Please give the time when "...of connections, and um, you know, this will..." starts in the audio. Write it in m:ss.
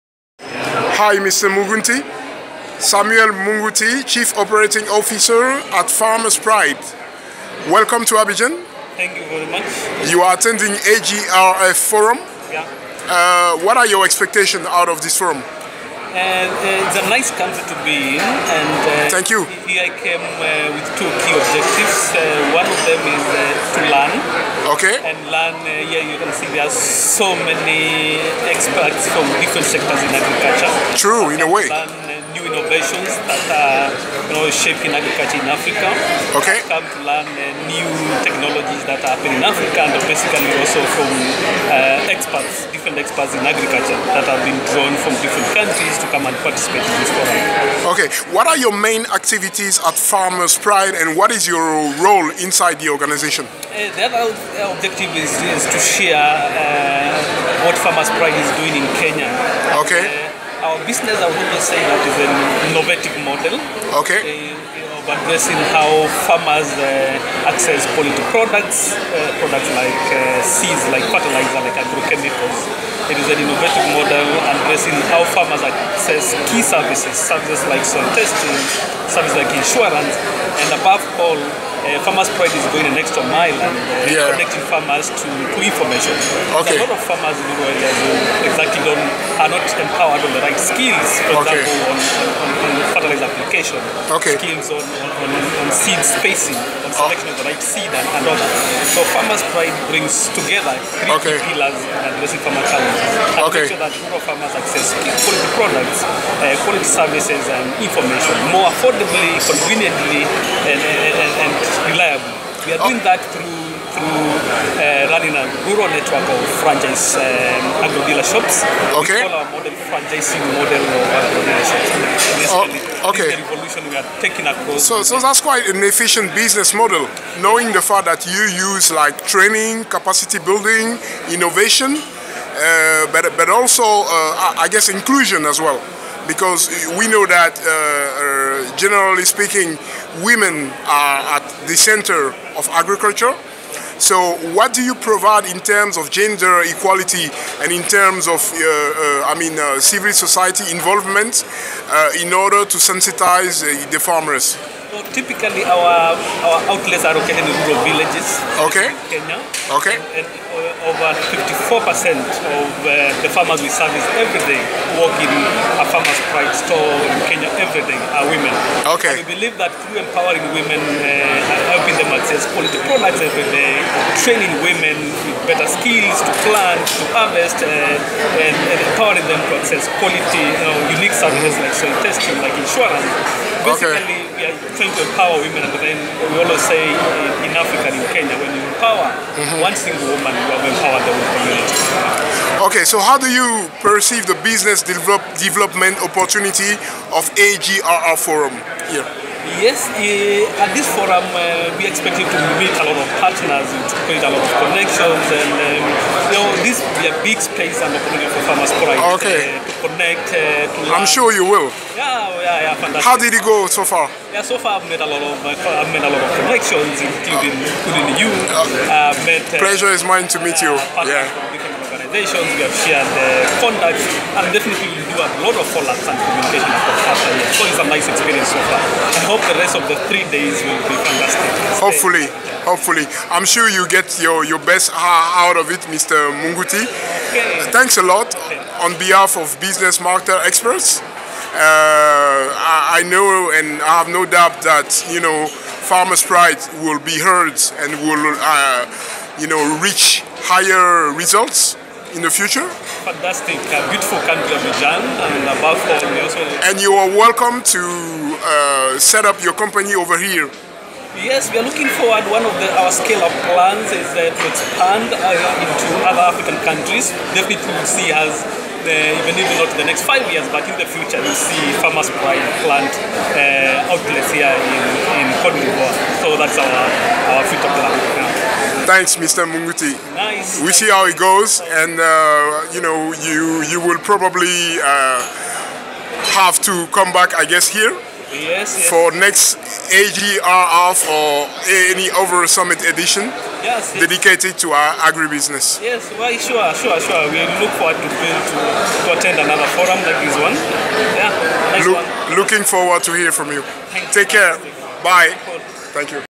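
3:24.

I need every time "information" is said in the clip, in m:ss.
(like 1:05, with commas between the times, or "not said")
1:25, 1:47.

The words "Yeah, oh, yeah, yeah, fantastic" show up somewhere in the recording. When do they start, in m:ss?
3:31.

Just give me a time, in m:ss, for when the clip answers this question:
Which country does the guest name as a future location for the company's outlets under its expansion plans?
4:35.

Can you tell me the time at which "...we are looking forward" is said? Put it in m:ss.
4:21.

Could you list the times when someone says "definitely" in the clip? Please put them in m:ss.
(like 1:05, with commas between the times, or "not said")
3:44, 4:27.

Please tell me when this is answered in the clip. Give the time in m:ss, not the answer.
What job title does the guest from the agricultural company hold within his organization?
0:04.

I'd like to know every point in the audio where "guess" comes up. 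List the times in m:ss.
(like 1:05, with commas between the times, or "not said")
2:14, 4:47.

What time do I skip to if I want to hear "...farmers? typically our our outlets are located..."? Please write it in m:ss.
2:33.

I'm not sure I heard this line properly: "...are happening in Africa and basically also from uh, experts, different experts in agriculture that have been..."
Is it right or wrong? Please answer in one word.
right.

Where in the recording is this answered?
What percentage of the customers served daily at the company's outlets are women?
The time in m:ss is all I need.
2:41.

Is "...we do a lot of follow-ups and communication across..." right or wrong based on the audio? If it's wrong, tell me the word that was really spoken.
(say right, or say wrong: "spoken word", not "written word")
right.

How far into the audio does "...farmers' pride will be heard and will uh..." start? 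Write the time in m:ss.
4:05.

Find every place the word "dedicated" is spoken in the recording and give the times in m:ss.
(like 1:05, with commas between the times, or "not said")
4:53.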